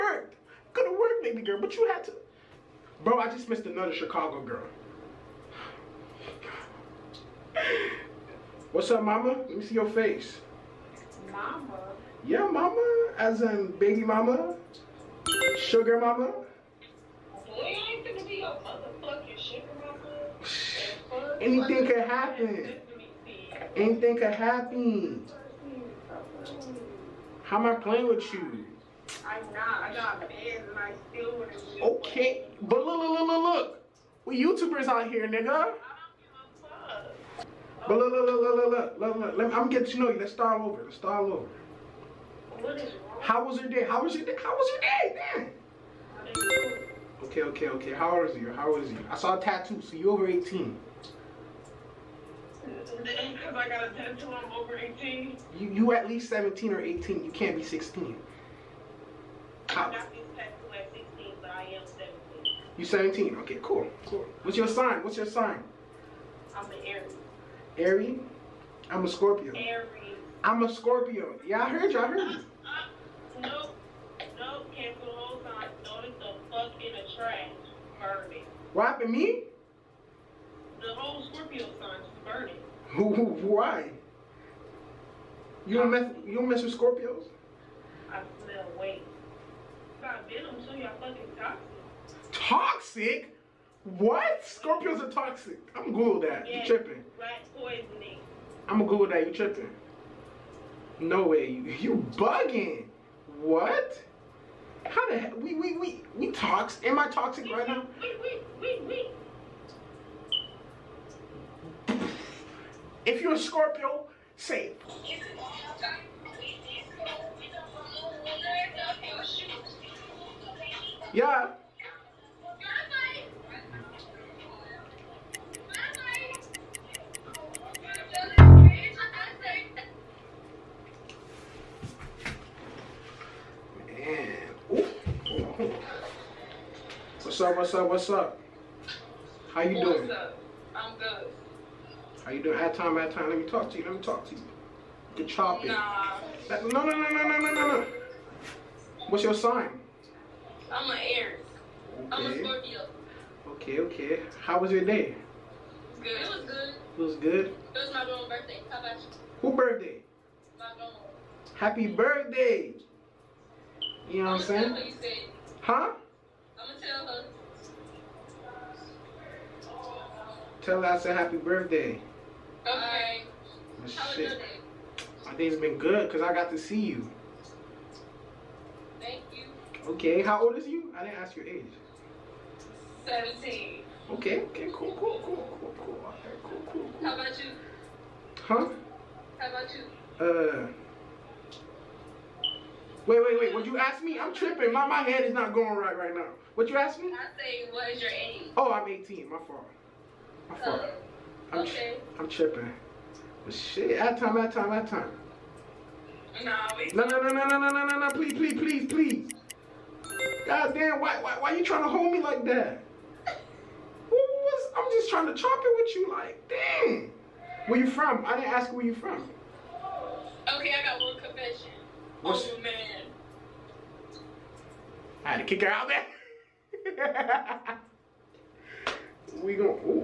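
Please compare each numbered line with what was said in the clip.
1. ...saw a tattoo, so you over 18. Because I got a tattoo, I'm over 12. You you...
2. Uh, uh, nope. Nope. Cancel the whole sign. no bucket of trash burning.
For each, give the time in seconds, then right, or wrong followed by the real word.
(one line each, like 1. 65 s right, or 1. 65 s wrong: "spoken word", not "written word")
1. 49 s wrong: "18", not "12"
2. 72 s right.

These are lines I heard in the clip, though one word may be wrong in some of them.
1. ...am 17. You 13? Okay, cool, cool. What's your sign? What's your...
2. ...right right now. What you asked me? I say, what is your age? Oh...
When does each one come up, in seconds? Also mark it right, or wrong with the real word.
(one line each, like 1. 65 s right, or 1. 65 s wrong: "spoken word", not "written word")
1. 61 s wrong: "17", not "13"
2. 195 s right.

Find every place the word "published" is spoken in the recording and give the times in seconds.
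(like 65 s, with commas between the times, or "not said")
not said.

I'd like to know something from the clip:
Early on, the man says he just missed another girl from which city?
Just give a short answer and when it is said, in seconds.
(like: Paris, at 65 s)
Chicago, at 3 s.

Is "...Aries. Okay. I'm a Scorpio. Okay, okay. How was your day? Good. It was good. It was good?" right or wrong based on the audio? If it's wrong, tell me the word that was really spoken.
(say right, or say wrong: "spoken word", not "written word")
right.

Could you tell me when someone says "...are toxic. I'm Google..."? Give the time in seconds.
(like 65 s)
95 s.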